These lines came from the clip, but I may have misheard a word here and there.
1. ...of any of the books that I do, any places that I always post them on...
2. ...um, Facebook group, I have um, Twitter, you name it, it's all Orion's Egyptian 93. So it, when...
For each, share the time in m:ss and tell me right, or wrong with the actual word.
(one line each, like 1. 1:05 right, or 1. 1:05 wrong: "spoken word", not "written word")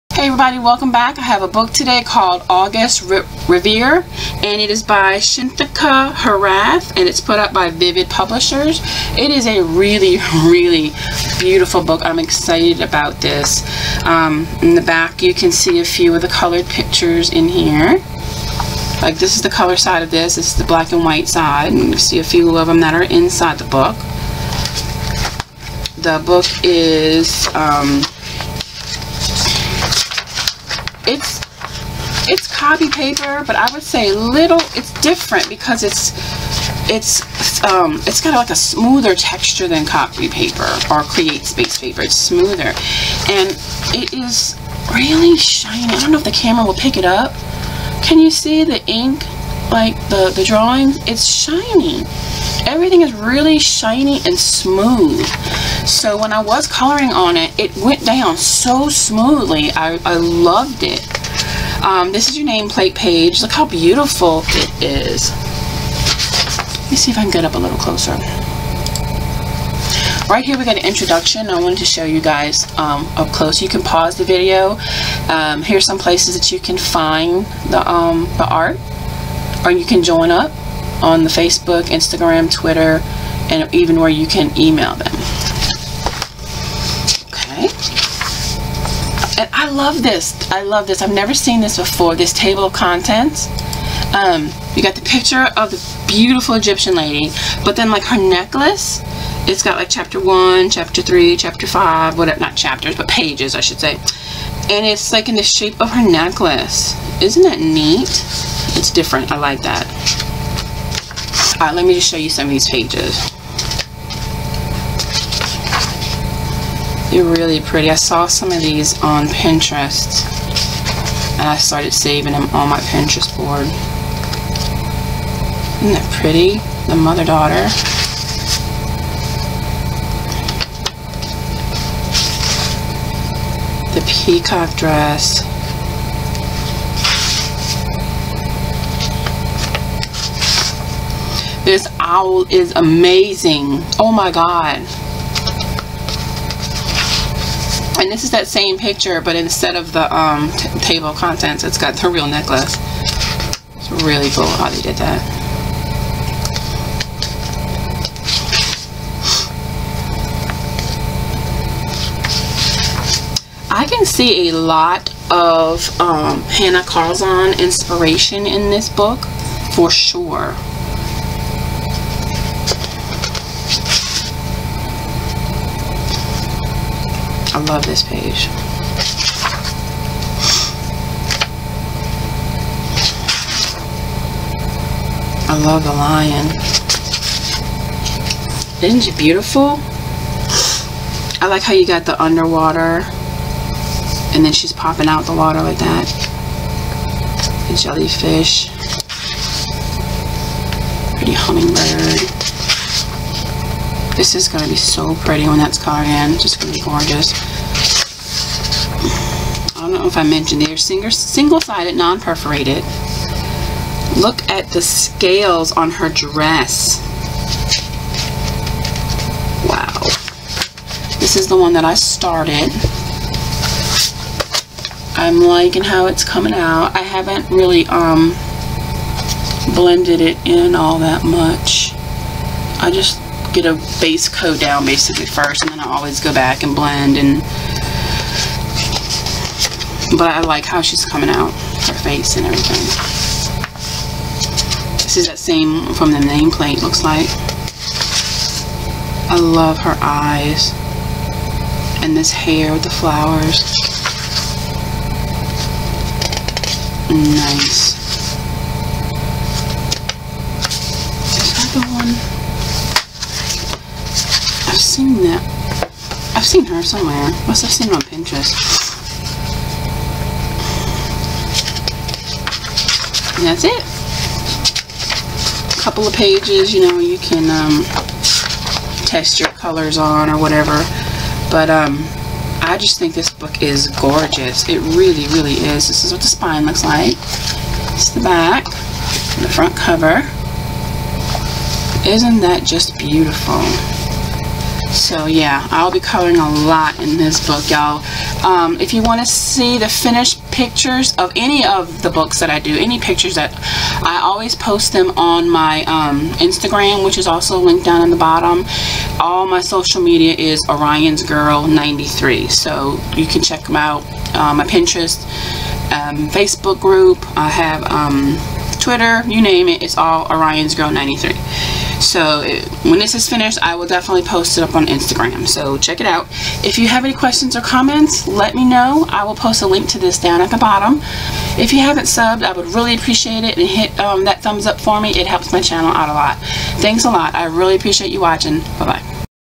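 1. 5:01 wrong: "pictures", not "places"
2. 5:15 wrong: "Girl", not "Egyptian".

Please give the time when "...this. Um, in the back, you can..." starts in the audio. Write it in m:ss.
0:13.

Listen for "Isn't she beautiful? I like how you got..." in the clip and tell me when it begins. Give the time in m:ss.
3:08.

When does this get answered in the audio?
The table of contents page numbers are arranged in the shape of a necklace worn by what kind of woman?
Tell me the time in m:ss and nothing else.
1:36.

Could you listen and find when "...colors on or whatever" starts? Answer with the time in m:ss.
4:39.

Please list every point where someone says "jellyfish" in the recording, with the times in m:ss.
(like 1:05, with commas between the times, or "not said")
3:17.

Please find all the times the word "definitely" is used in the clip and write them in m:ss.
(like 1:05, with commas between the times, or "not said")
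5:23.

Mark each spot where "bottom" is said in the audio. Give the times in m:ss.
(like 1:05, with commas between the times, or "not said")
5:08, 5:30.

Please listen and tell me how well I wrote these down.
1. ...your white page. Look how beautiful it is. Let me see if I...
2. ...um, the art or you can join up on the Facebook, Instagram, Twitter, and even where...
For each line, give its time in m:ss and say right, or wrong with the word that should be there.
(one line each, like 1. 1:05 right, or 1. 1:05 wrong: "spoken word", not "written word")
1. 1:02 wrong: "nameplate", not "white"
2. 1:17 right.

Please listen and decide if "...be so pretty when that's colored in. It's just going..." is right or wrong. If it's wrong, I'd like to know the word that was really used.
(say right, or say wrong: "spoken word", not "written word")
right.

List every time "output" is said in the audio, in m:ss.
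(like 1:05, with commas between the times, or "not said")
not said.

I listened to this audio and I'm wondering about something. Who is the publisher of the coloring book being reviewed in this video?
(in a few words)
Vivid Publishers.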